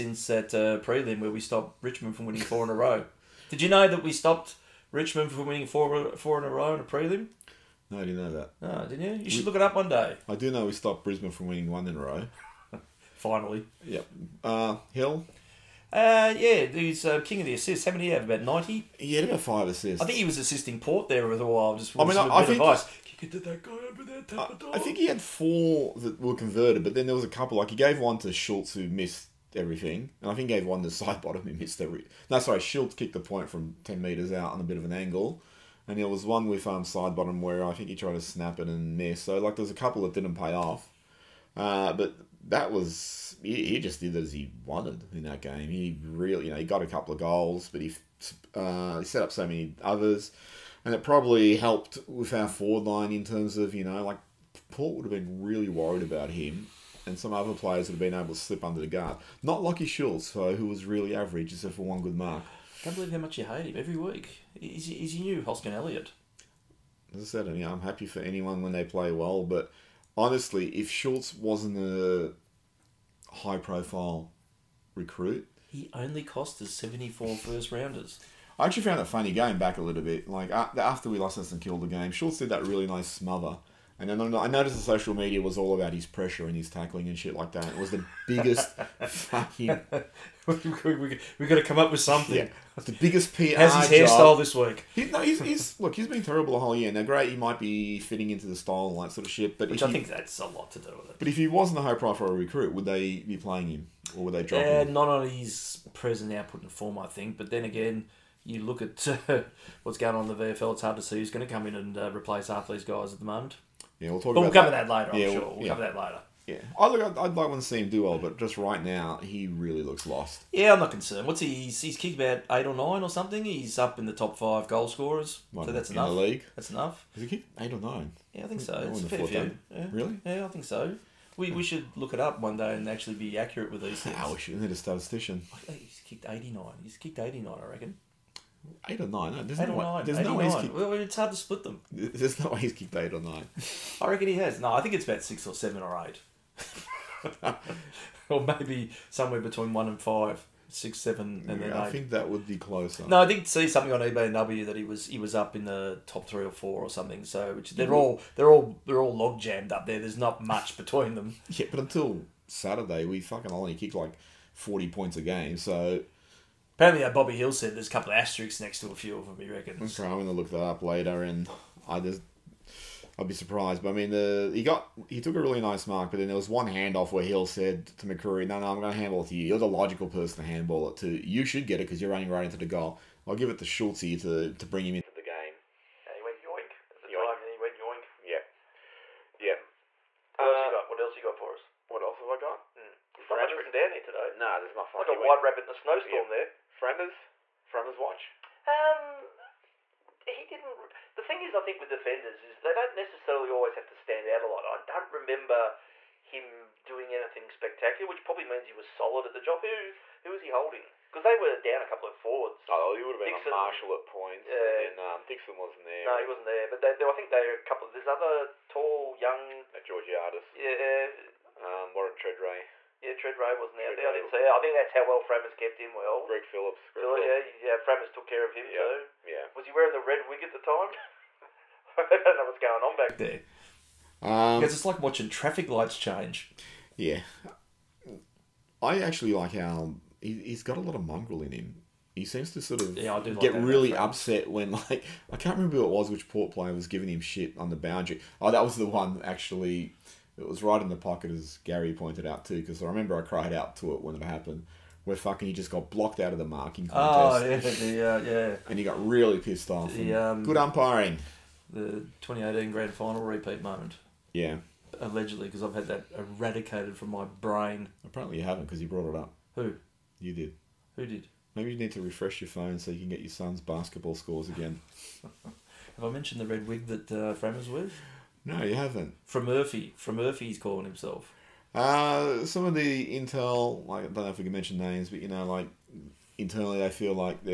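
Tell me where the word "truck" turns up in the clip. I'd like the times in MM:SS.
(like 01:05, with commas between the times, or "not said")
not said.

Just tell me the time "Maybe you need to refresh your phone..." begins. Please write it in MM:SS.
04:31.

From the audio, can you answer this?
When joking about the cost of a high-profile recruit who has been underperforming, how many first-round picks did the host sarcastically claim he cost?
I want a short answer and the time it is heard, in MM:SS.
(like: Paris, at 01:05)
74, at 01:16.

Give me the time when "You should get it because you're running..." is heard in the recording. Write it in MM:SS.
03:01.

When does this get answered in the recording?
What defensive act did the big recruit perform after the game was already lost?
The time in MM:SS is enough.
01:23.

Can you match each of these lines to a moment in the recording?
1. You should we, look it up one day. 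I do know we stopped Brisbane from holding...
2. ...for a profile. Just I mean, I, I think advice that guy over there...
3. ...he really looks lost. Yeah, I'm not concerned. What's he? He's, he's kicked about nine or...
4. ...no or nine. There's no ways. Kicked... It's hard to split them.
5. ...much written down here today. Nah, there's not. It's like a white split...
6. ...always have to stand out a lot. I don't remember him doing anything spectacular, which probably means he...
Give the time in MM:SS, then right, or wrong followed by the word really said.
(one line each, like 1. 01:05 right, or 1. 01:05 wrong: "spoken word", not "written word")
1. 00:09 wrong: "winning", not "holding"
2. 00:21 wrong: "while", not "profile"
3. 01:59 wrong: "eight", not "nine"
4. 02:19 right
5. 03:13 wrong: "rabbit", not "split"
6. 03:23 right.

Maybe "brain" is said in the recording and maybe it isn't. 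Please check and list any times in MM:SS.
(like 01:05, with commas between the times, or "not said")
04:27.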